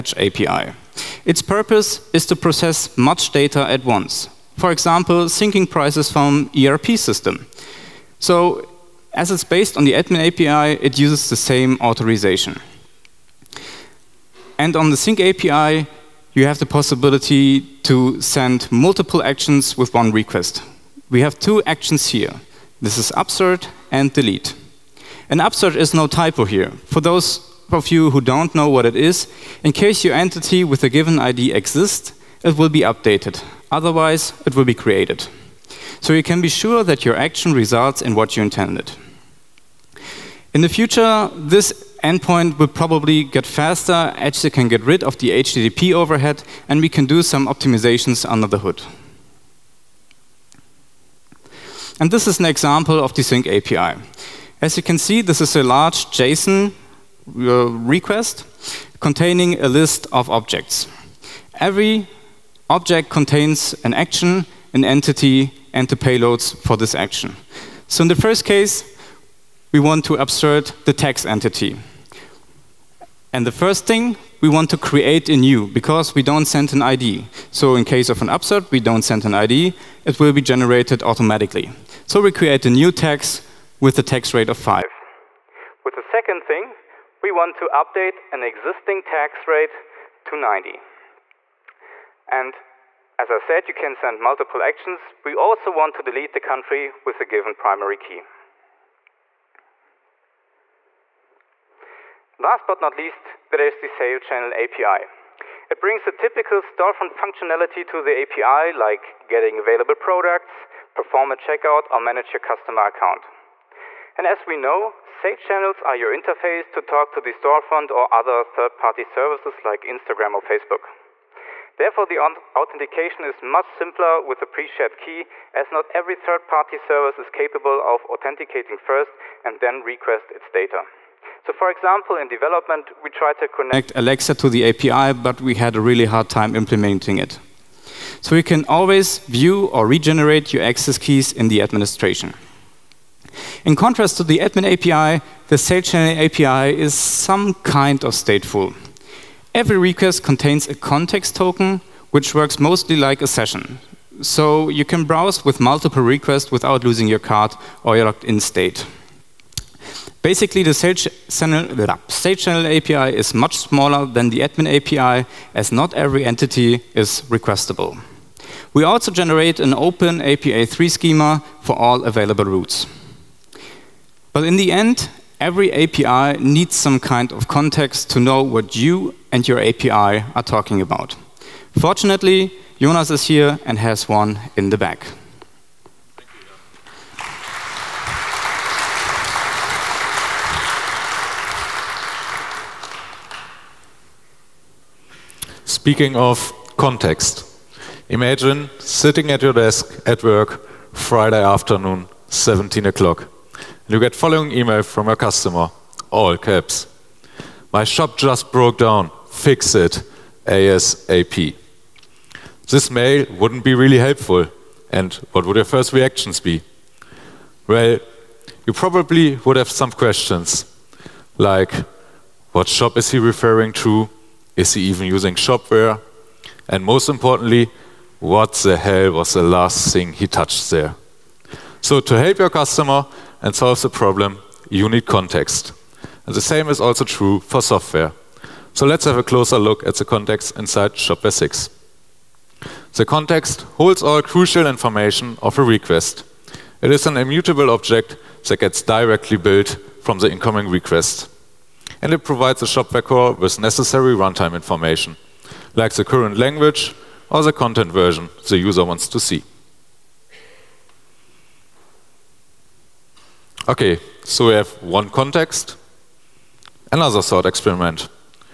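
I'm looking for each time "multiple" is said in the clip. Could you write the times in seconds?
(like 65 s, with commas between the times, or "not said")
18 s, 94 s, 155 s.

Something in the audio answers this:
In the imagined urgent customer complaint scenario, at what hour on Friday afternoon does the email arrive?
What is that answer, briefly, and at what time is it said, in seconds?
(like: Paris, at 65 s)
17 o'clock, at 202 s.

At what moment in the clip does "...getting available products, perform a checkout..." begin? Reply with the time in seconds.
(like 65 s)
109 s.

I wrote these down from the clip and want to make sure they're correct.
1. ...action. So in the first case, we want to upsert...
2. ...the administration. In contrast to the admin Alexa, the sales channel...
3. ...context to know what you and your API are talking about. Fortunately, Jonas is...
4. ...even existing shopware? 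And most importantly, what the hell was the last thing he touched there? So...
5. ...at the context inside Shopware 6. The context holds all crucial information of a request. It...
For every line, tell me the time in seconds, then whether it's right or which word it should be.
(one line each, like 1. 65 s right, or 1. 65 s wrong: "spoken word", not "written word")
1. 66 s right
2. 141 s wrong: "API", not "Alexa"
3. 177 s right
4. 224 s wrong: "using", not "existing"
5. 239 s right.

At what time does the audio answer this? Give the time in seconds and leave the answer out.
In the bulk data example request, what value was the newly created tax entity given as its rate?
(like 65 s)
84 s.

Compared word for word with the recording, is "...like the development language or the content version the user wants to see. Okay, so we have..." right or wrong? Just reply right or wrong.
wrong.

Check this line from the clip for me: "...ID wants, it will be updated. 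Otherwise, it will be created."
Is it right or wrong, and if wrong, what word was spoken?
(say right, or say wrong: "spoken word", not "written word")
wrong: "exists", not "wants".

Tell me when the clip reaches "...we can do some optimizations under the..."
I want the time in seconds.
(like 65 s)
46 s.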